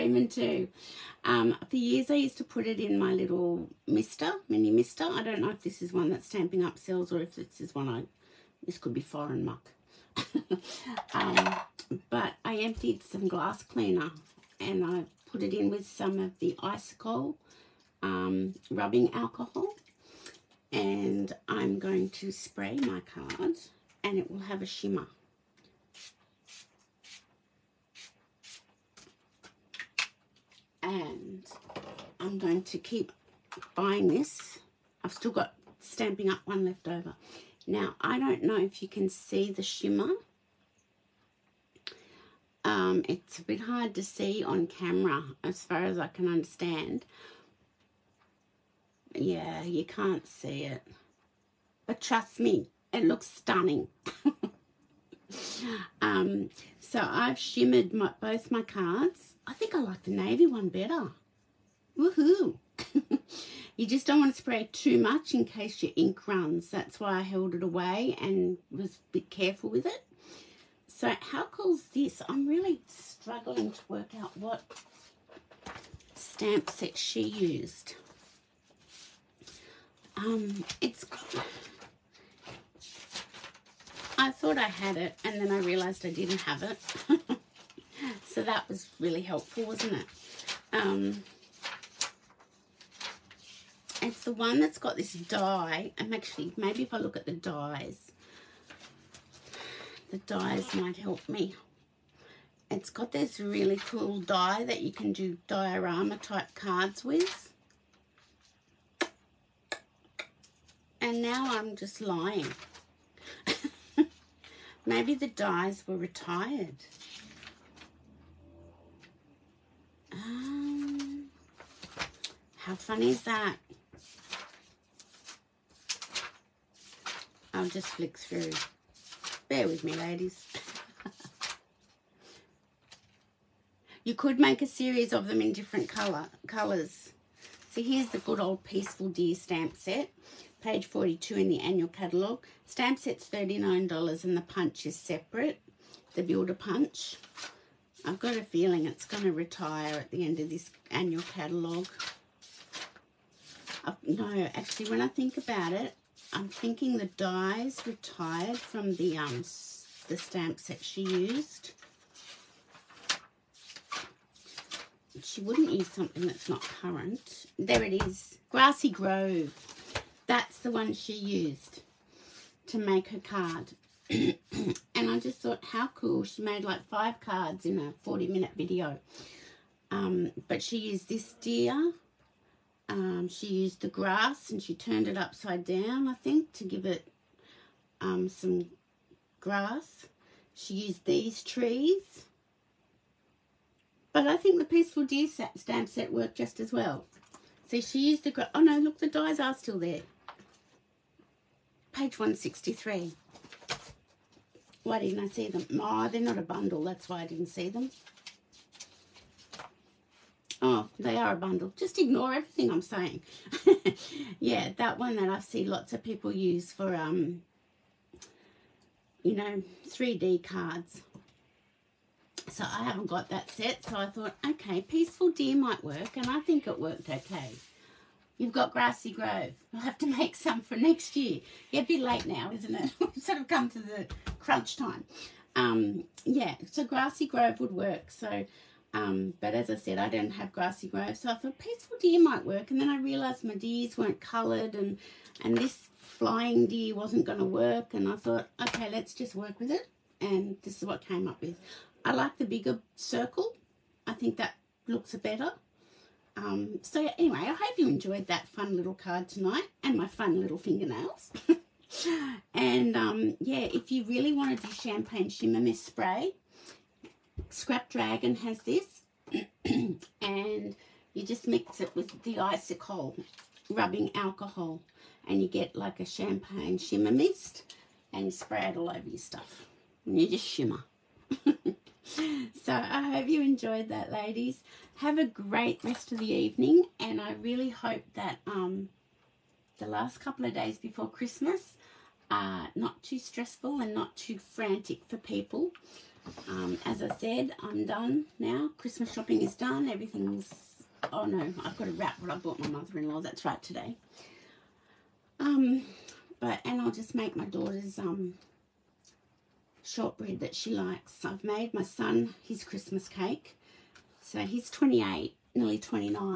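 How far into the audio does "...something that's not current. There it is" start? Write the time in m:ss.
2:45.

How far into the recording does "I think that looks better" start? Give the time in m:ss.
4:14.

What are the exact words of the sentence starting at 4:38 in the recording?
And you spray it all over your stuff.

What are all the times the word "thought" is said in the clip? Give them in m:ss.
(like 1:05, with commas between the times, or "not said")
1:24, 2:55, 3:44, 4:01, 4:08.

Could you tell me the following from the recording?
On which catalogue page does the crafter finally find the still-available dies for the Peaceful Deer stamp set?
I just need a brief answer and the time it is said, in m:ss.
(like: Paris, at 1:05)
163, at 3:21.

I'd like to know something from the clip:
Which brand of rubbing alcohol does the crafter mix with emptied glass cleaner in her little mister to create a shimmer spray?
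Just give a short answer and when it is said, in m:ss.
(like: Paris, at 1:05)
Isocol, at 0:16.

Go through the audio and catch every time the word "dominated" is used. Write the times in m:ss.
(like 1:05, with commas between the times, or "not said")
not said.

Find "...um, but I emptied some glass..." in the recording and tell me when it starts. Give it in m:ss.
0:11.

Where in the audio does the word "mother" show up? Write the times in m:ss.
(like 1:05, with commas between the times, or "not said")
5:02.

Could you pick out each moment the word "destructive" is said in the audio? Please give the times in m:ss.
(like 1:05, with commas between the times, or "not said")
not said.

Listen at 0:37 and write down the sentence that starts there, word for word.
Now, I don't know if you can see the shimmer.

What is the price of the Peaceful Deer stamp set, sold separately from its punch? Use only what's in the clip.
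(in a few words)
$39.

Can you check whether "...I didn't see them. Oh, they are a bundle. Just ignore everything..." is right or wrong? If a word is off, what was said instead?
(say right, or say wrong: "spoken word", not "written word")
right.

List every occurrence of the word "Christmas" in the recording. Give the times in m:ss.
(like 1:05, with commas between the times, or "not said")
4:51, 4:58, 5:12.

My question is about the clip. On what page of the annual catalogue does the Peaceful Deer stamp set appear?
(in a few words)
42.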